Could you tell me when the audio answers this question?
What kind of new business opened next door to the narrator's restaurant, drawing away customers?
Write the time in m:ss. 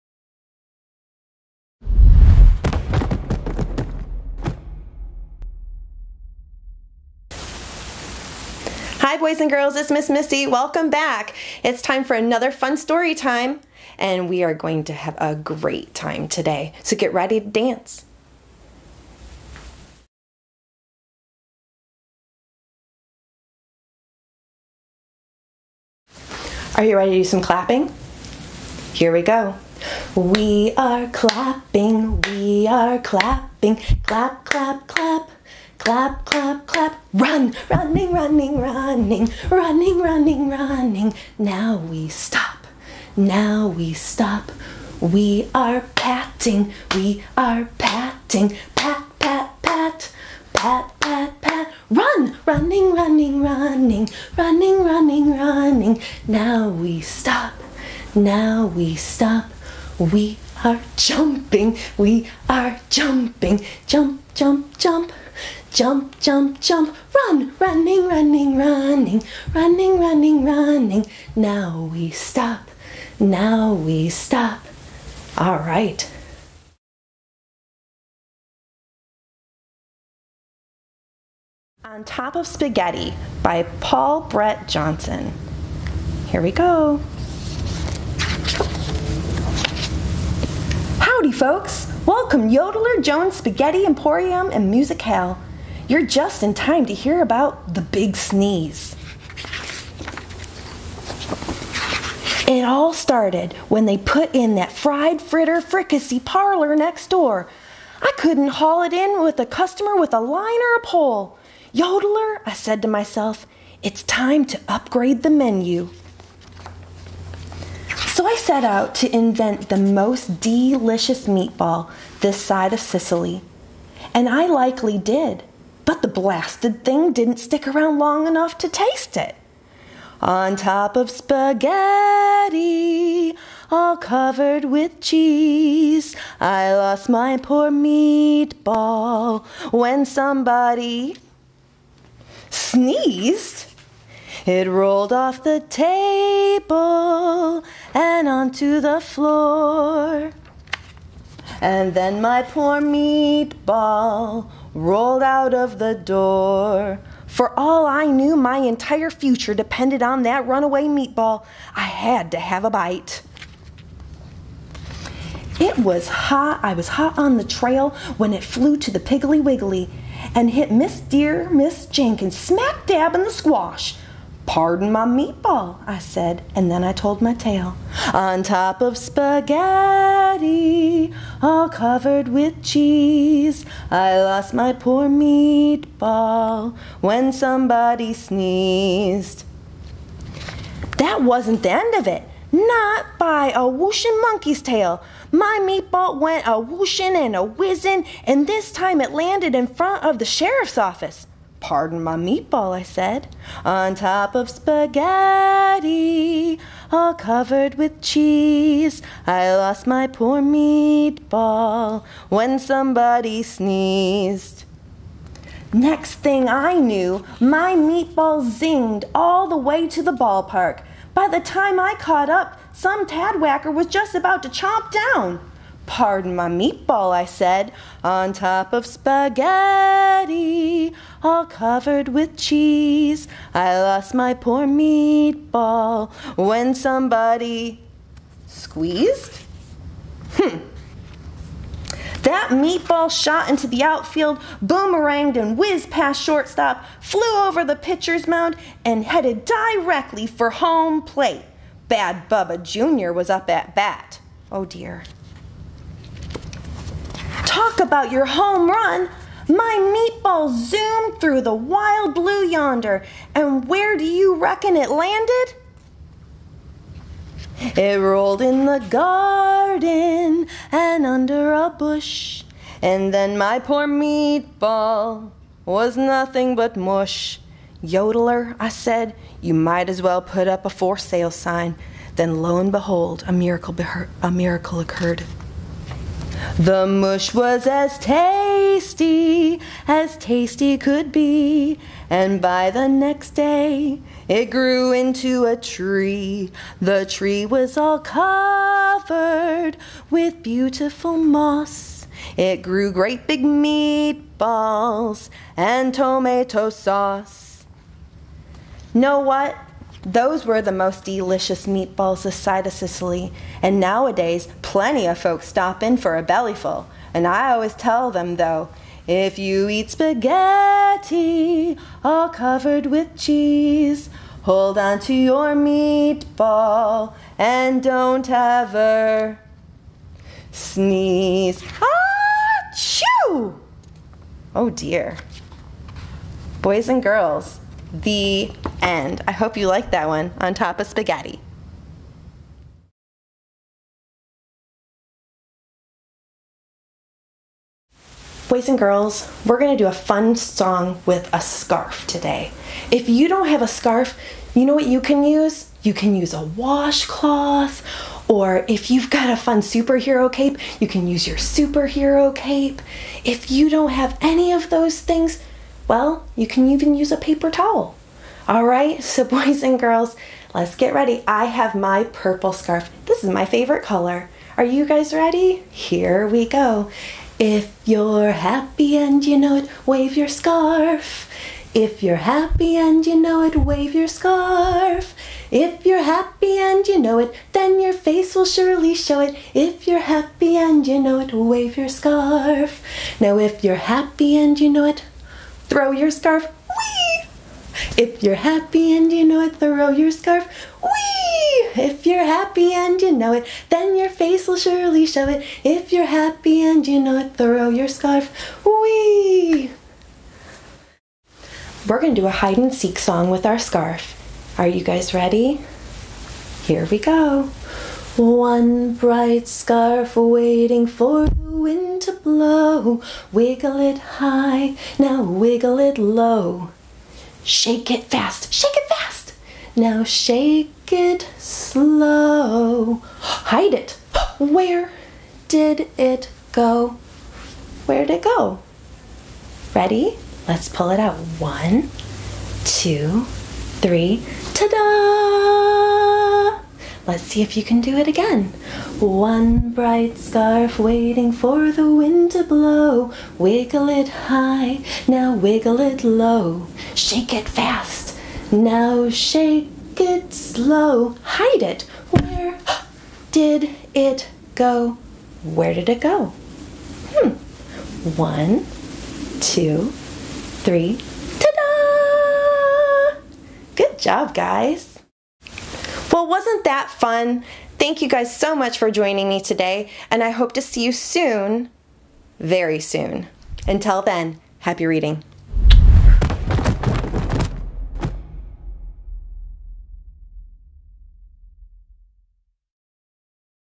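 1:44.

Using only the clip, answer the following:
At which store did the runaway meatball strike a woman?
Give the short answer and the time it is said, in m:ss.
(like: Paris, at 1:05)
Piggly Wiggly, at 2:48.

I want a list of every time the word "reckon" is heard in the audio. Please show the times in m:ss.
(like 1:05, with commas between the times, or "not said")
4:24.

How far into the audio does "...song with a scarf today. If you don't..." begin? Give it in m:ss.
5:50.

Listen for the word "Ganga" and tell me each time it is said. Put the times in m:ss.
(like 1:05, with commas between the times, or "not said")
not said.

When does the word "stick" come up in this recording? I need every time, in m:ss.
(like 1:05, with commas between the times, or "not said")
2:07.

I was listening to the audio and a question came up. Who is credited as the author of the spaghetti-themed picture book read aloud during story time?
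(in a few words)
Paul Brett Johnson.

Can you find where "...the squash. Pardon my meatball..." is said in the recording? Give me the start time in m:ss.
2:53.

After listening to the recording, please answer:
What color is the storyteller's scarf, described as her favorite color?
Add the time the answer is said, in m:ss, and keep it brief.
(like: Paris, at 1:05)
purple, at 6:12.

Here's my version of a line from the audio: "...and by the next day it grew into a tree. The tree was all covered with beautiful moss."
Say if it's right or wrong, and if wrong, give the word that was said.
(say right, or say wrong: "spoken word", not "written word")
right.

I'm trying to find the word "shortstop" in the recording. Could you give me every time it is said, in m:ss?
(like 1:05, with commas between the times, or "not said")
4:06.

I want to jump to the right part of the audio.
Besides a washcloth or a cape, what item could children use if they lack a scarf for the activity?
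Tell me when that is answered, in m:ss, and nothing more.
6:07.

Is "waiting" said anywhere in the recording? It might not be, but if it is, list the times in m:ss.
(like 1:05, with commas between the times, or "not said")
7:00, 7:30.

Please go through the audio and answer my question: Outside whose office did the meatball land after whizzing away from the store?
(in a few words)
the sheriff's office.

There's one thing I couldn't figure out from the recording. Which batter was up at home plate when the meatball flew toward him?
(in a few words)
Bad Bubba Jr.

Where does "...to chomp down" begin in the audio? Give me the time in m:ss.
3:44.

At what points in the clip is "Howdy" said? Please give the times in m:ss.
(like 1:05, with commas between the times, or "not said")
1:31.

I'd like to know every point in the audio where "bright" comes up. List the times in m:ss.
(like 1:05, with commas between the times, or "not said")
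6:58, 7:29.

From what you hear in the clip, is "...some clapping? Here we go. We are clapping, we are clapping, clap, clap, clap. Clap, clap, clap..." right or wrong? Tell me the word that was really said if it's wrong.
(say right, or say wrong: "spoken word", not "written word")
right.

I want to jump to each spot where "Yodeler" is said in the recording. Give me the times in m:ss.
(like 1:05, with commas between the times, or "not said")
1:32, 1:51, 4:37.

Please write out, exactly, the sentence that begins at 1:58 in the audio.
So I set out to invent the most delicious meatball this side of Sicily.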